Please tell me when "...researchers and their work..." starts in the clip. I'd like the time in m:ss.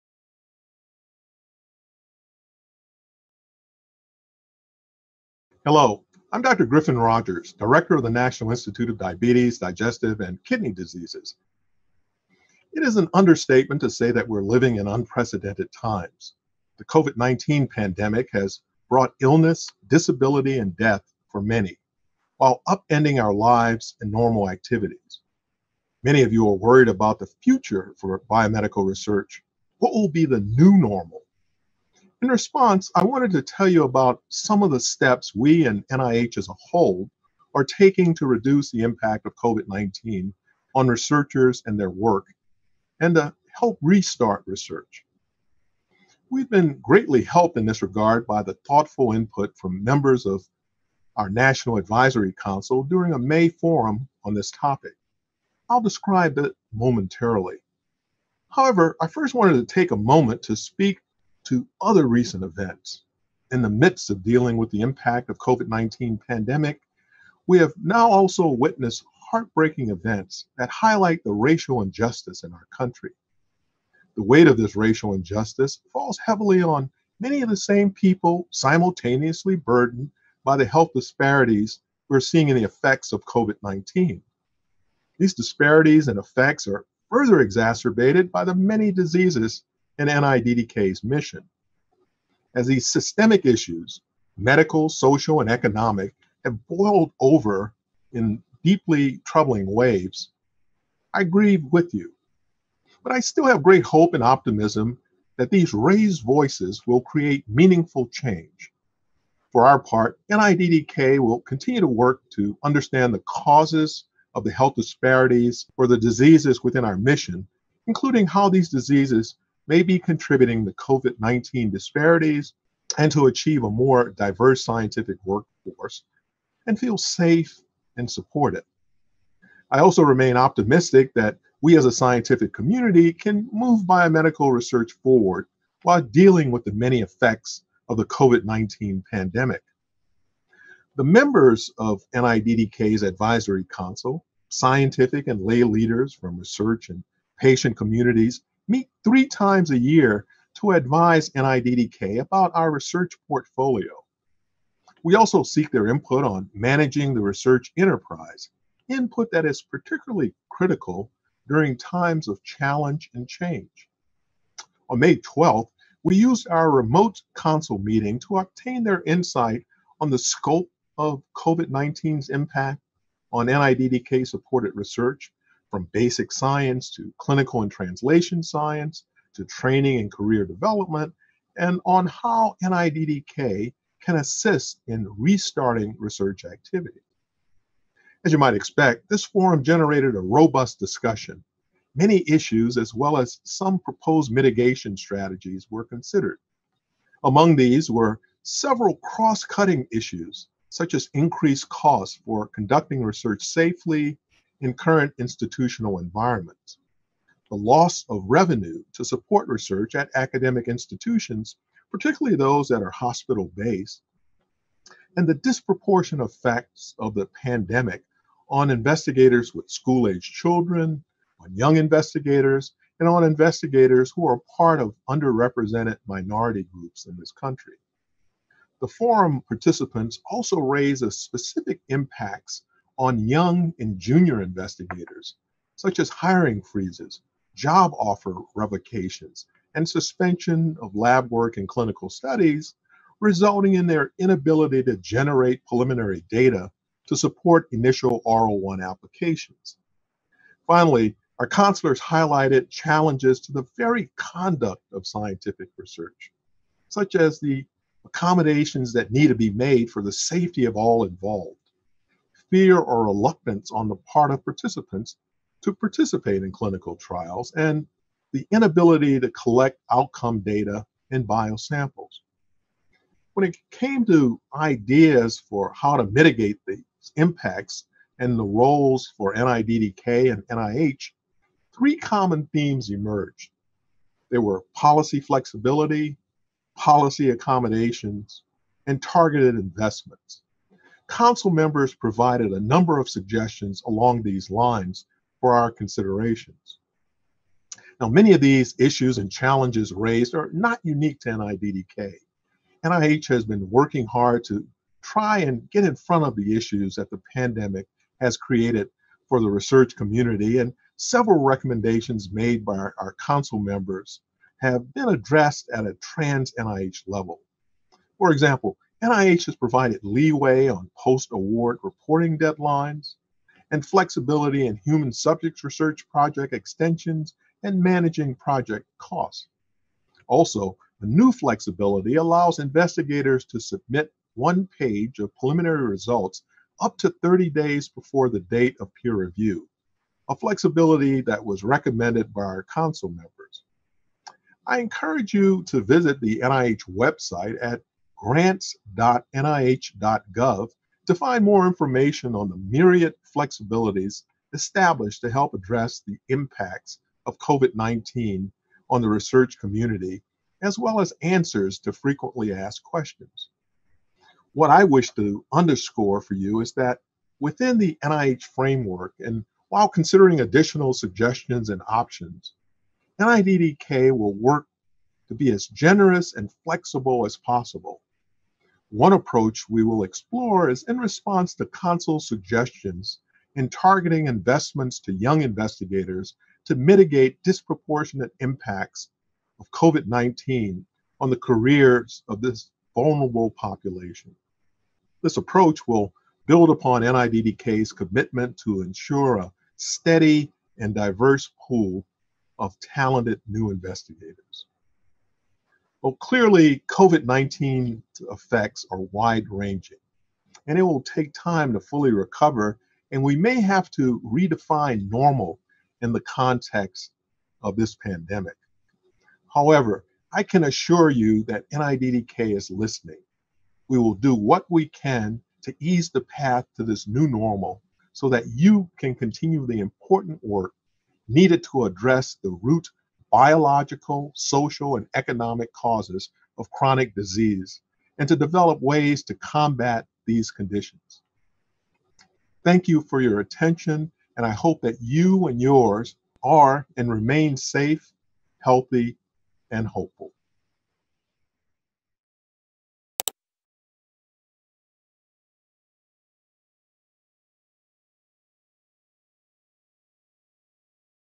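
0:40.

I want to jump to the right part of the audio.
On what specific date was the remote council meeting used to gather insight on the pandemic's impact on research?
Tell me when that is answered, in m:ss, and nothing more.
2:44.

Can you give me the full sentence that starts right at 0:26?
Many of you are worried about the future for biomedical research.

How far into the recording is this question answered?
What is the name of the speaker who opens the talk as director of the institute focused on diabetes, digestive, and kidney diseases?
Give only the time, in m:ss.
0:06.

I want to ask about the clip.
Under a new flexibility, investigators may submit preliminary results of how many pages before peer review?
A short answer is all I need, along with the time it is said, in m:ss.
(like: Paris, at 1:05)
1 page, at 5:34.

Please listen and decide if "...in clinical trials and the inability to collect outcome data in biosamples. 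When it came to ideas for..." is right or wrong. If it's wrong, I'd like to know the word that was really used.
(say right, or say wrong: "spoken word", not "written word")
right.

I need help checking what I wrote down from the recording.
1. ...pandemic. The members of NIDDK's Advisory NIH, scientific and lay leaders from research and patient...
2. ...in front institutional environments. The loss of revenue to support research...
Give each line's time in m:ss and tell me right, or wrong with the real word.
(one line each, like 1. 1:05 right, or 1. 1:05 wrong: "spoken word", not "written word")
1. 2:19 wrong: "Council", not "NIH"
2. 3:24 wrong: "current", not "front".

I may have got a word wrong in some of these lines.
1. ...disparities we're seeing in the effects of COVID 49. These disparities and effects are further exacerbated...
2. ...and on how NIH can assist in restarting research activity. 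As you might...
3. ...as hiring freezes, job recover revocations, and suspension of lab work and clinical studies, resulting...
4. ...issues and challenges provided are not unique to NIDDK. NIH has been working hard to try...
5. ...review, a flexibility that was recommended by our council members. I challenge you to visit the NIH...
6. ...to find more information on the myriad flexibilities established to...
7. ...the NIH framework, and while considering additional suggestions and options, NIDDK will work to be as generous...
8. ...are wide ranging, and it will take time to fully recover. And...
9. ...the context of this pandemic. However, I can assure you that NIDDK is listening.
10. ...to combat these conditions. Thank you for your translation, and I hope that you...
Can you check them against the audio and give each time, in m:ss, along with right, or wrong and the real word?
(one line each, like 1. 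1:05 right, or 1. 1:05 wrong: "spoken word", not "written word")
1. 1:20 wrong: "19", not "49"
2. 3:01 wrong: "NIDDK", not "NIH"
3. 3:55 wrong: "offer", not "recover"
4. 4:58 wrong: "raised", not "provided"
5. 5:39 wrong: "encourage", not "challenge"
6. 5:51 right
7. 6:07 right
8. 6:48 right
9. 6:56 right
10. 7:19 wrong: "attention", not "translation".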